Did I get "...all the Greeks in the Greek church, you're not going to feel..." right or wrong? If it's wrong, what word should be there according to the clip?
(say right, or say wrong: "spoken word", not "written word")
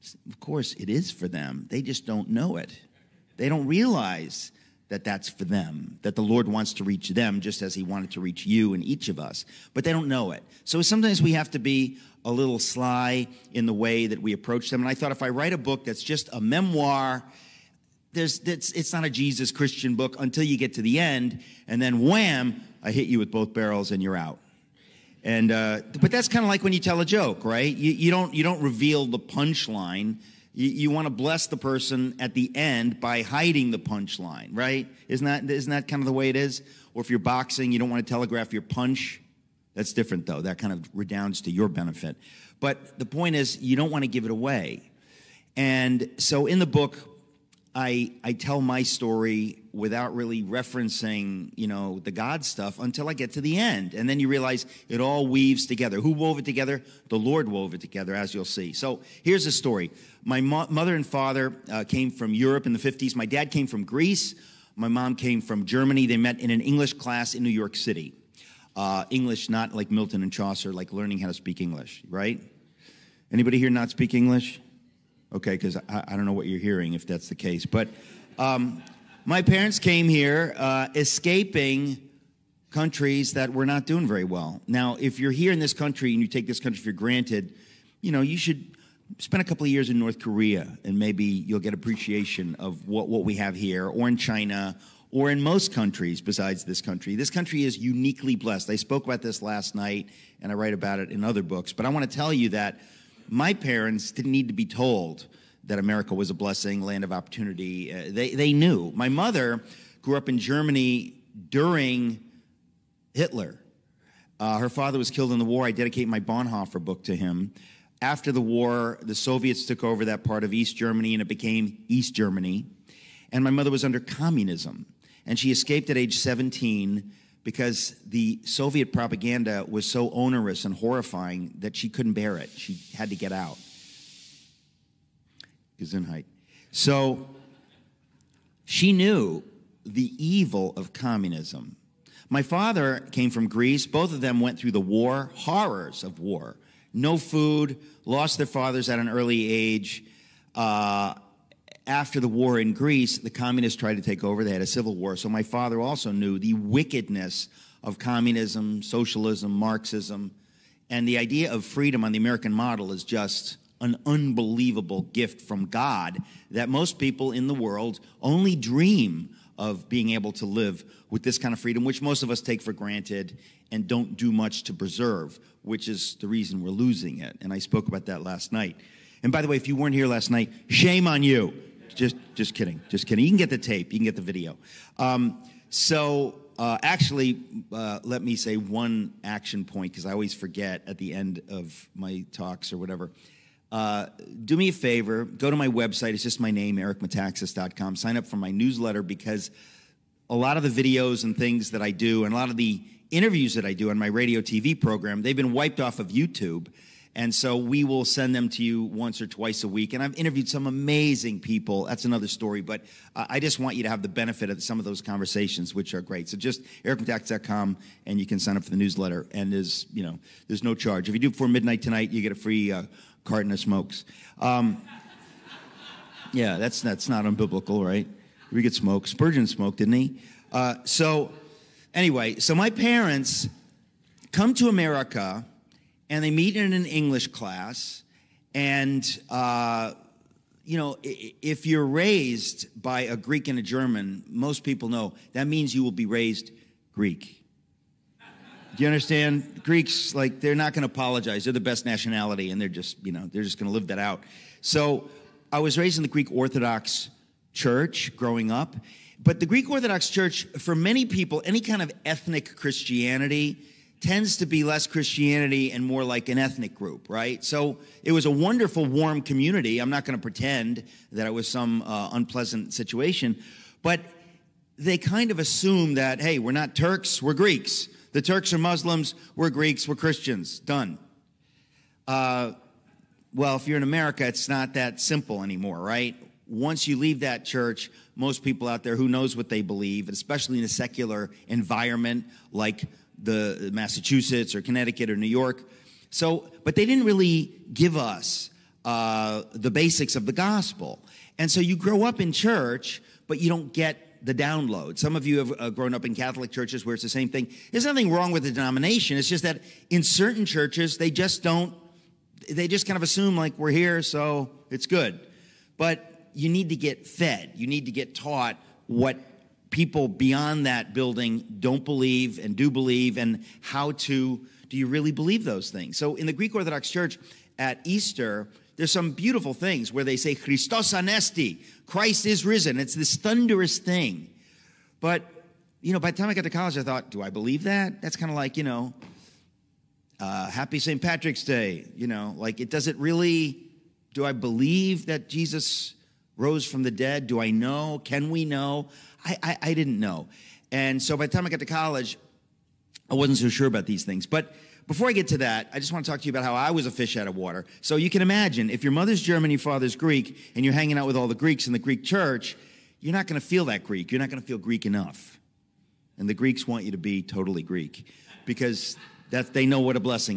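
right.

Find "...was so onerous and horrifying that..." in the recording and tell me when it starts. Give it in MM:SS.
02:09.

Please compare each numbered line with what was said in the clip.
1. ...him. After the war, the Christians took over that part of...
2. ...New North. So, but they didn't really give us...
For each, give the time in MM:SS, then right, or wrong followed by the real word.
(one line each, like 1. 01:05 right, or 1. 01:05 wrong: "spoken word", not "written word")
1. 01:57 wrong: "Soviets", not "Christians"
2. 04:55 wrong: "York", not "North".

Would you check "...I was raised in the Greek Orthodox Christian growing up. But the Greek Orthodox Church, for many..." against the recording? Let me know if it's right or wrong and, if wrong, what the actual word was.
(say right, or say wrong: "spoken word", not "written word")
wrong: "Church", not "Christian".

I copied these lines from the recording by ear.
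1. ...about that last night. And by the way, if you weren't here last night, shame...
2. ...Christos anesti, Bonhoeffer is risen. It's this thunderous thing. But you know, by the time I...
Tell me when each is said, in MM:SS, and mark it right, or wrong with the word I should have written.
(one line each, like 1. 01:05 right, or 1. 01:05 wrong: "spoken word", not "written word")
1. 02:57 right
2. 05:30 wrong: "Christ", not "Bonhoeffer".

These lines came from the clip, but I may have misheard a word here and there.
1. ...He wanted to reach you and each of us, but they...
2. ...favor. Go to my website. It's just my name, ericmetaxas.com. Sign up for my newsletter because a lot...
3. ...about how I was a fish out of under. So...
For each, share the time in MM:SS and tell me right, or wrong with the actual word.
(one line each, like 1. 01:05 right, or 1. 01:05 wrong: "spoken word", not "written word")
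1. 00:07 right
2. 03:14 right
3. 05:56 wrong: "water", not "under".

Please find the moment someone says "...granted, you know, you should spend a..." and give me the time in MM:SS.
01:26.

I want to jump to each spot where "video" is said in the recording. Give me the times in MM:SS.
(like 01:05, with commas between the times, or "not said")
03:04, 03:20.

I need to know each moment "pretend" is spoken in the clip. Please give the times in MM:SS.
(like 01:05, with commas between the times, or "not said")
04:30.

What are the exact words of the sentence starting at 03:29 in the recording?
And I've interviewed some amazing people.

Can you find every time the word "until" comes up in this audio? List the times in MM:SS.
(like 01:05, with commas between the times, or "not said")
00:20, 00:52.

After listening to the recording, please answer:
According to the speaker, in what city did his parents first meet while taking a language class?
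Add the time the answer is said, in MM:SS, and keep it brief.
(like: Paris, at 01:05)
New York City, at 01:07.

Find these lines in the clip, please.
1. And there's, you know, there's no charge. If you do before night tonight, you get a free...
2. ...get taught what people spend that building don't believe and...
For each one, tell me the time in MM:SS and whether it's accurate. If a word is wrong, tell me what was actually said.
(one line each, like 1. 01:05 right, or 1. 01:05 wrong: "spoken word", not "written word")
1. 03:39 wrong: "midnight", not "night"
2. 05:17 wrong: "beyond", not "spend".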